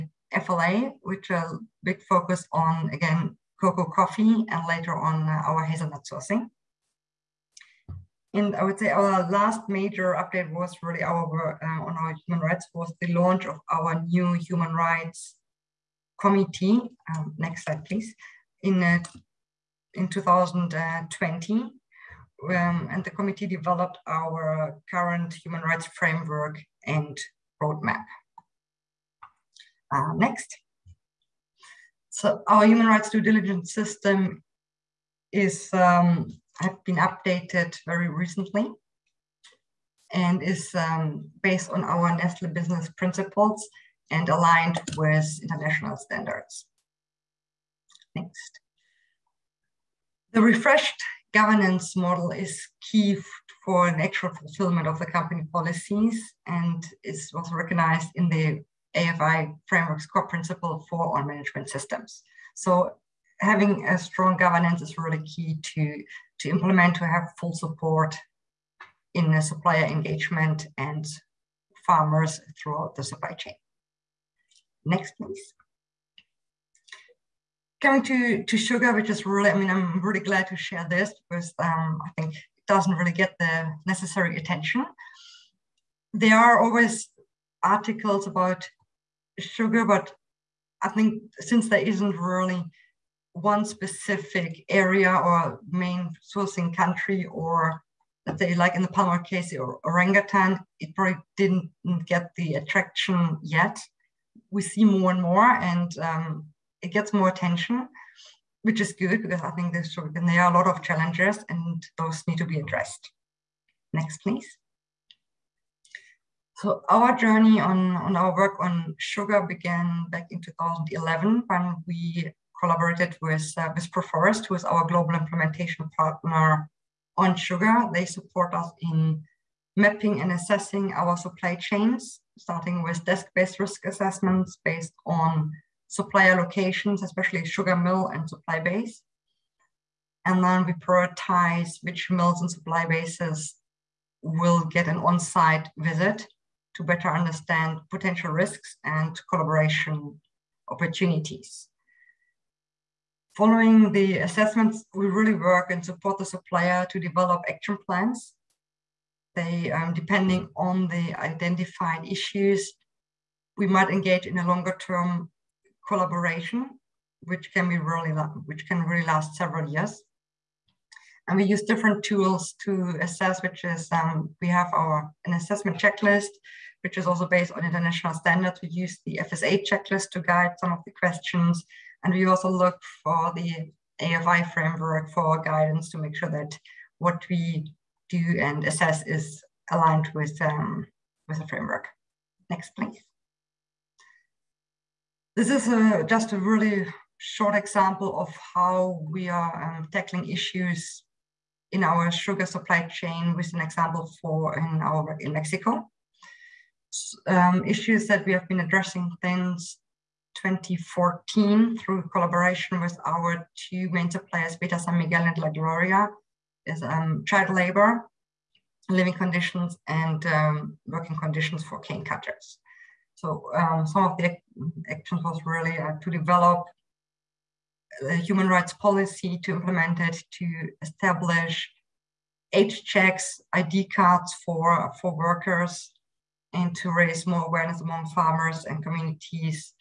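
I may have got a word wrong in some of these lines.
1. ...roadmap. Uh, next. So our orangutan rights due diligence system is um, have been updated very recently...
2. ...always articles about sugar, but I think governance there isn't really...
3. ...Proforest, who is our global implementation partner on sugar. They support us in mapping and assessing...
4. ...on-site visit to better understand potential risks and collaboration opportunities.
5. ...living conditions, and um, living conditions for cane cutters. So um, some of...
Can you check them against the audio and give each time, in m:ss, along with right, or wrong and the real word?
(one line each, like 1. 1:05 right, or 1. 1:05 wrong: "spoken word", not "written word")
1. 0:27 wrong: "human", not "orangutan"
2. 1:26 wrong: "since", not "governance"
3. 2:03 right
4. 2:24 right
5. 3:38 wrong: "working", not "living".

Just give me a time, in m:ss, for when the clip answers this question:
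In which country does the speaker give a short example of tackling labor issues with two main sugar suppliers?
3:25.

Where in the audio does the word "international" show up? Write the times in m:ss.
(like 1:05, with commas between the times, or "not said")
0:45, 2:57.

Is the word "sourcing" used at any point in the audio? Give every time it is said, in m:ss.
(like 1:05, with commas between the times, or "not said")
0:06, 1:36.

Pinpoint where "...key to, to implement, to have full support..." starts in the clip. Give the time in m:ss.
1:05.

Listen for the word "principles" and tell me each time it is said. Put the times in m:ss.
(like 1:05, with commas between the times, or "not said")
0:42, 1:00.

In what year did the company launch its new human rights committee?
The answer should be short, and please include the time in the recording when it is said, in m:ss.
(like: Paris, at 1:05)
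2020, at 0:20.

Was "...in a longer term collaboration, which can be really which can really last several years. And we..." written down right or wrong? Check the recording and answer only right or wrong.
right.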